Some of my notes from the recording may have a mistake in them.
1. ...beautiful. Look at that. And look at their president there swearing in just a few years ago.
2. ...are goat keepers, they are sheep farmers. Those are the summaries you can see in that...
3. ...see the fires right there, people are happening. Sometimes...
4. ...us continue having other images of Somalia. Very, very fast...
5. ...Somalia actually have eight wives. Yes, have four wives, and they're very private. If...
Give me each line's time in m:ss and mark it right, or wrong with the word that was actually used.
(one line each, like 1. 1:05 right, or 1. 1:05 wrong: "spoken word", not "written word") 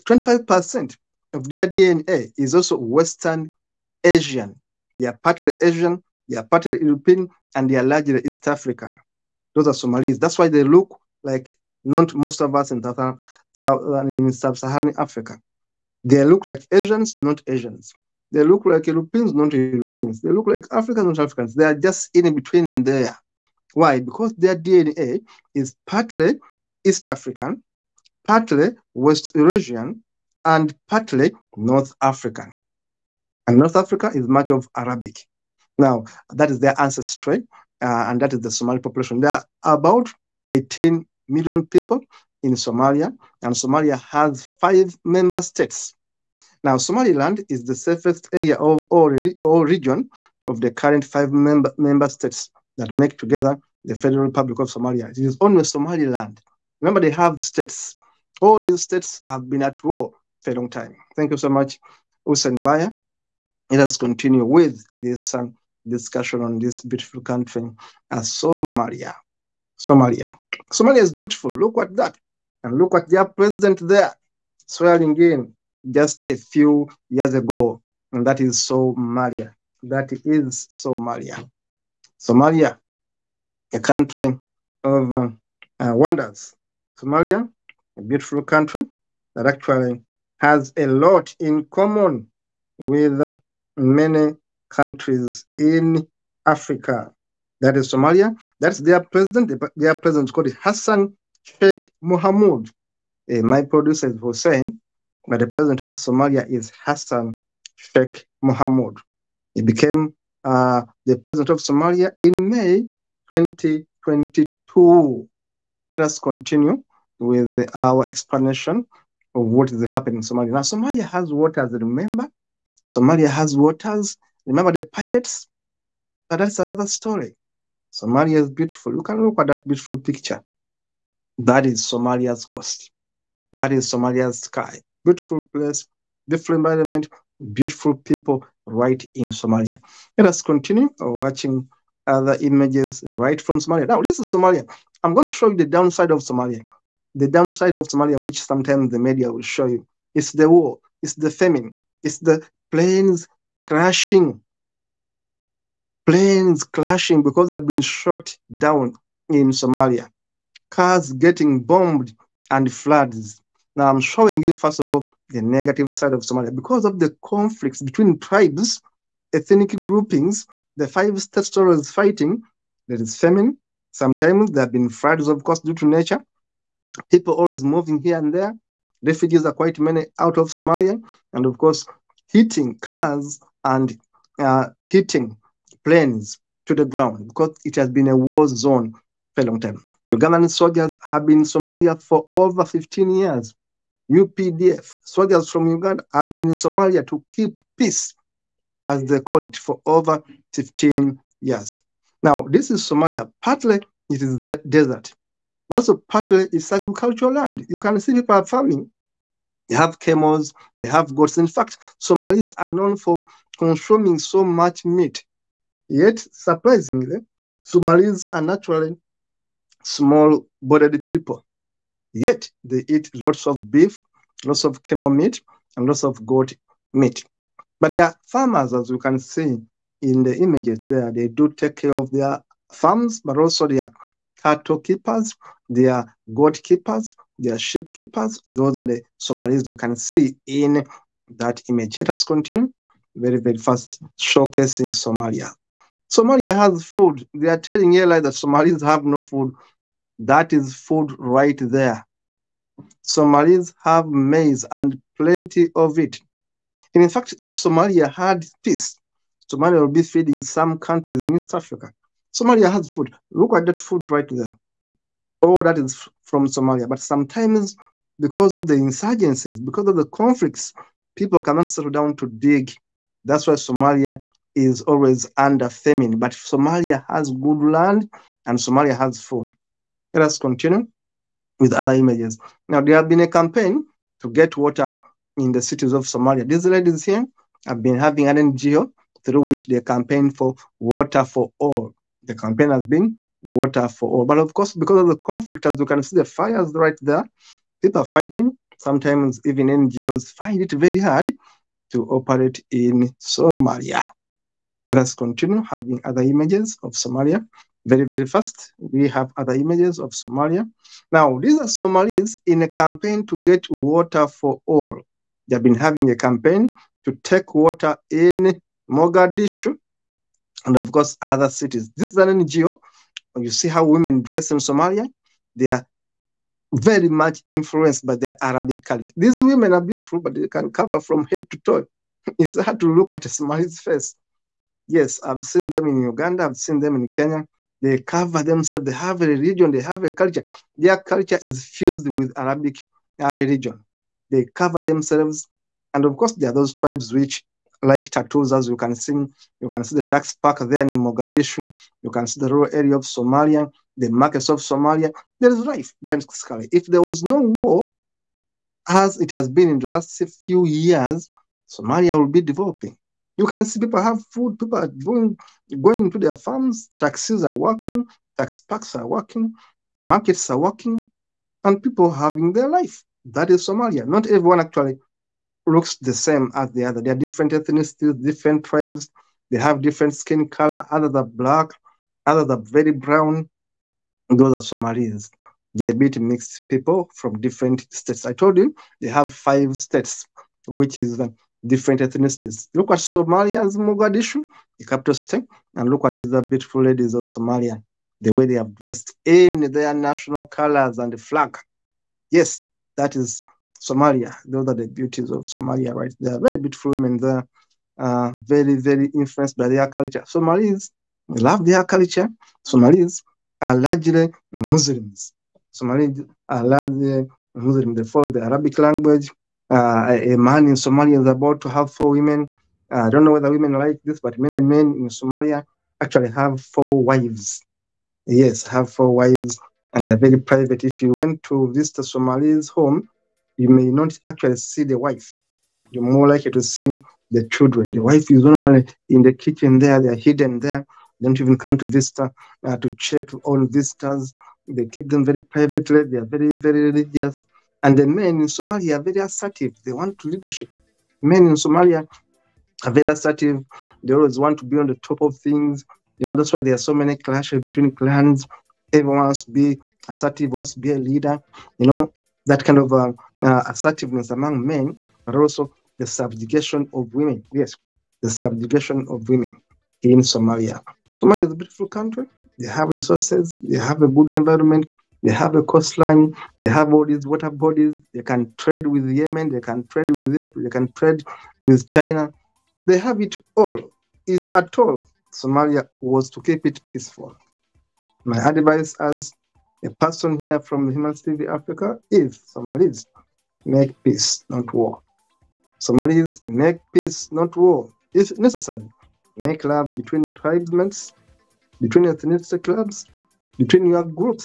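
1. 1:11 right
2. 3:55 wrong: "keepers", not "farmers"
3. 4:56 wrong: "fighting", not "happening"
4. 5:04 right
5. 7:05 wrong: "four", not "eight".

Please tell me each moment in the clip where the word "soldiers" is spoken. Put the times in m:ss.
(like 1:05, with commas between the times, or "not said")
3:10, 3:15.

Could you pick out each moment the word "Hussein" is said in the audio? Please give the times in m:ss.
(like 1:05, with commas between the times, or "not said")
1:02, 1:44.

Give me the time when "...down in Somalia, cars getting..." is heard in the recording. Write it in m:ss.
2:38.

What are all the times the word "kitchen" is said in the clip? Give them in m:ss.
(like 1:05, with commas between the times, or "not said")
7:19.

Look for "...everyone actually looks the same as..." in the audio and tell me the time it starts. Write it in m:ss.
6:14.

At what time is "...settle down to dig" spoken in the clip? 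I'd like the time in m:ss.
4:31.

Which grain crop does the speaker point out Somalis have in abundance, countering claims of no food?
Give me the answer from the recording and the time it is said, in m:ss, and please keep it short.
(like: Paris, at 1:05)
maize, at 4:14.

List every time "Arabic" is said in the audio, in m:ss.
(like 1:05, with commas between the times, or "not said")
0:34, 5:28, 5:42, 6:58.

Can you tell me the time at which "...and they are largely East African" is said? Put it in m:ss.
0:07.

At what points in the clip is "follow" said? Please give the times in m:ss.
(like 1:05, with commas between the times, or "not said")
6:58.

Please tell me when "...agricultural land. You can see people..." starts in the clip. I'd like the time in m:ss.
3:26.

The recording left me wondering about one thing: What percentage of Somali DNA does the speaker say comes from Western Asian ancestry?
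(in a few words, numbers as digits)
25%.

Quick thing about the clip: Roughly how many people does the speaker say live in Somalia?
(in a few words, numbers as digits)
18 million.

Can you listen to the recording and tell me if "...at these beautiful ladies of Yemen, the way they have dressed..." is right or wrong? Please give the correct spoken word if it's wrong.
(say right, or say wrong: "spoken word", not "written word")
wrong: "Somalia", not "Yemen".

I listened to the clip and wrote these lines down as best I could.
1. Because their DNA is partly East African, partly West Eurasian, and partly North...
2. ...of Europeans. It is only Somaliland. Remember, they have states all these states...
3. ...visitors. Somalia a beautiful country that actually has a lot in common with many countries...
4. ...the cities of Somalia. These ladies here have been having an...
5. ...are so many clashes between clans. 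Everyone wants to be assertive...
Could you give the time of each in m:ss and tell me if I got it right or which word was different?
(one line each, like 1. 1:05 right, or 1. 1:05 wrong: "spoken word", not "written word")
1. 0:24 right
2. 0:54 wrong: "Somalia", not "Europeans"
3. 1:25 wrong: "wonders", not "visitors"
4. 4:45 right
5. 7:36 right.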